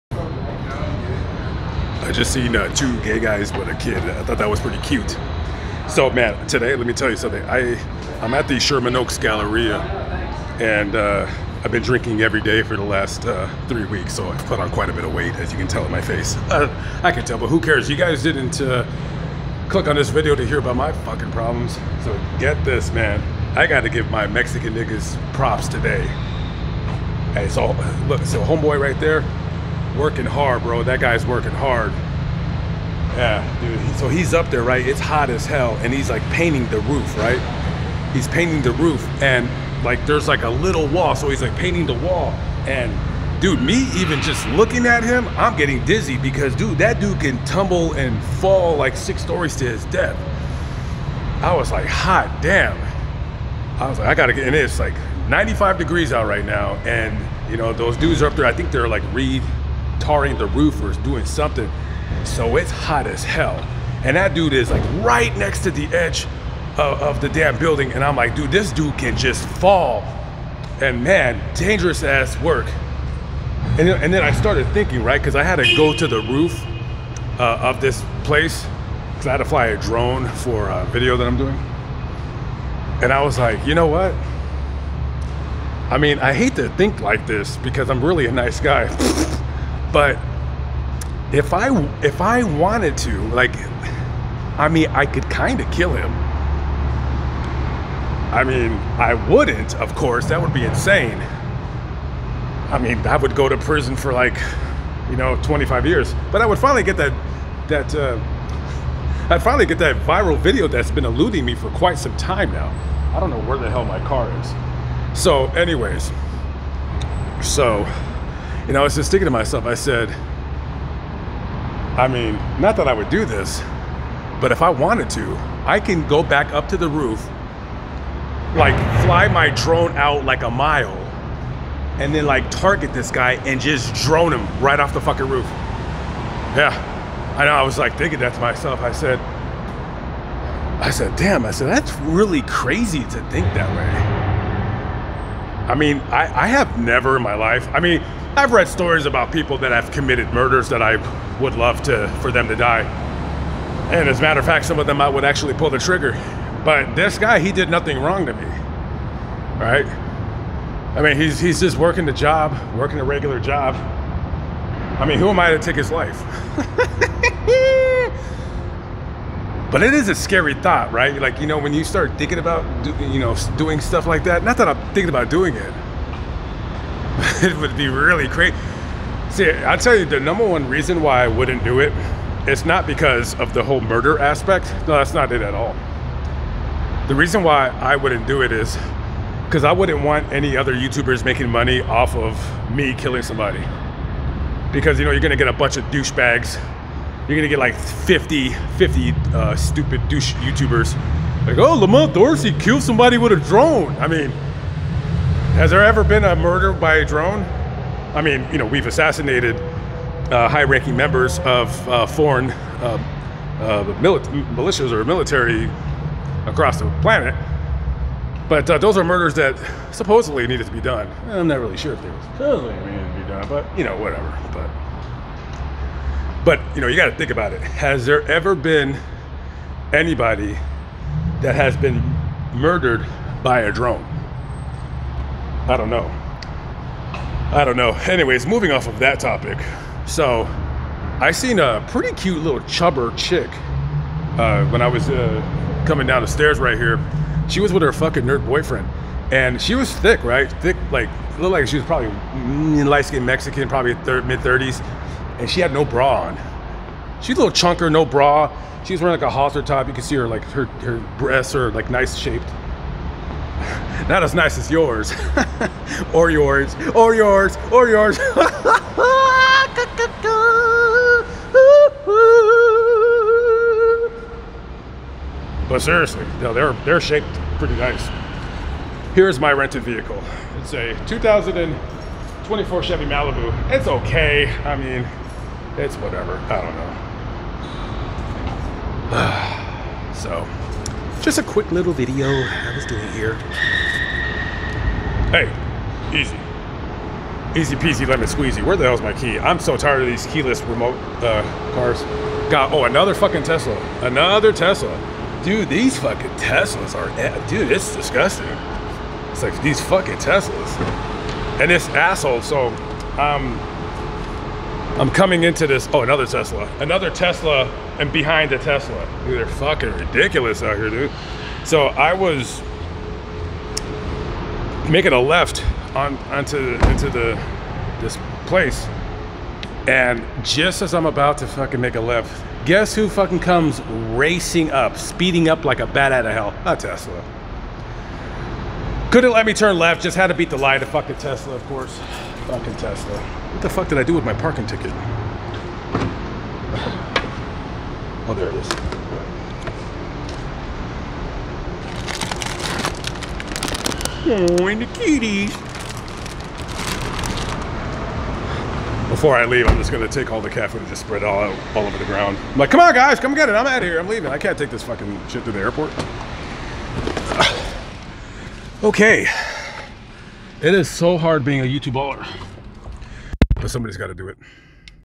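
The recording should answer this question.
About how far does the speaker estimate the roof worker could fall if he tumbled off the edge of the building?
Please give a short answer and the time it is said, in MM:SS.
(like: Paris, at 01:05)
6 stories, at 00:48.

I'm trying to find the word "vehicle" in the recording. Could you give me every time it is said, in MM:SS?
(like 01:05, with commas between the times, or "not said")
04:39.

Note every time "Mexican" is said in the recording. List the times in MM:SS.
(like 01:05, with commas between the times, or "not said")
00:24, 04:13.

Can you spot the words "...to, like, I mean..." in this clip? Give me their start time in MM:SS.
01:32.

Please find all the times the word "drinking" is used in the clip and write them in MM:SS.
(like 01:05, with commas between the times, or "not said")
00:11.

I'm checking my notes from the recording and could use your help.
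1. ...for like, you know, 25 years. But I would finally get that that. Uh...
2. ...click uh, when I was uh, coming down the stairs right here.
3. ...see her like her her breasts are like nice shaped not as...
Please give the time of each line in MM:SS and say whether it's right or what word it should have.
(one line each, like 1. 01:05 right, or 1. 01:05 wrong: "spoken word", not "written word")
1. 01:43 right
2. 04:03 wrong: "chick", not "click"
3. 04:20 right.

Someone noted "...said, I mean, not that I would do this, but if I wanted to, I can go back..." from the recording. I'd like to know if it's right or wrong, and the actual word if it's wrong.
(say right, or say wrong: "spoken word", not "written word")
right.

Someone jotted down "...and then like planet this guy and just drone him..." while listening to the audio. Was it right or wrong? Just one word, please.
wrong.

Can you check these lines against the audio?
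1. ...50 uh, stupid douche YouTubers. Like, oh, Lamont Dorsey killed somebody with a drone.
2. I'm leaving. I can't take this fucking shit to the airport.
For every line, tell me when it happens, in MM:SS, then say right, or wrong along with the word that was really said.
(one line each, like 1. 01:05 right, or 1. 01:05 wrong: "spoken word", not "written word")
1. 03:18 right
2. 06:03 right.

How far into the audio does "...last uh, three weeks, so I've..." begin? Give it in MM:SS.
00:12.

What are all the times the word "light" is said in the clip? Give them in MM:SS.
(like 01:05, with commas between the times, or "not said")
04:12, 05:40.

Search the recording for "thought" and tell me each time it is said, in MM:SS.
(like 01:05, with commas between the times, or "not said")
00:04, 02:50.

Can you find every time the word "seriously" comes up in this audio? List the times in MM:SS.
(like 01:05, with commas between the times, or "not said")
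04:35.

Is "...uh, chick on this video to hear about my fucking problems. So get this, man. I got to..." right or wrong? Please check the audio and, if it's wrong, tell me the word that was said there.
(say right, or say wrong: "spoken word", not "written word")
wrong: "click", not "chick".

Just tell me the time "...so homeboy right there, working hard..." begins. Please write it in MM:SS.
00:28.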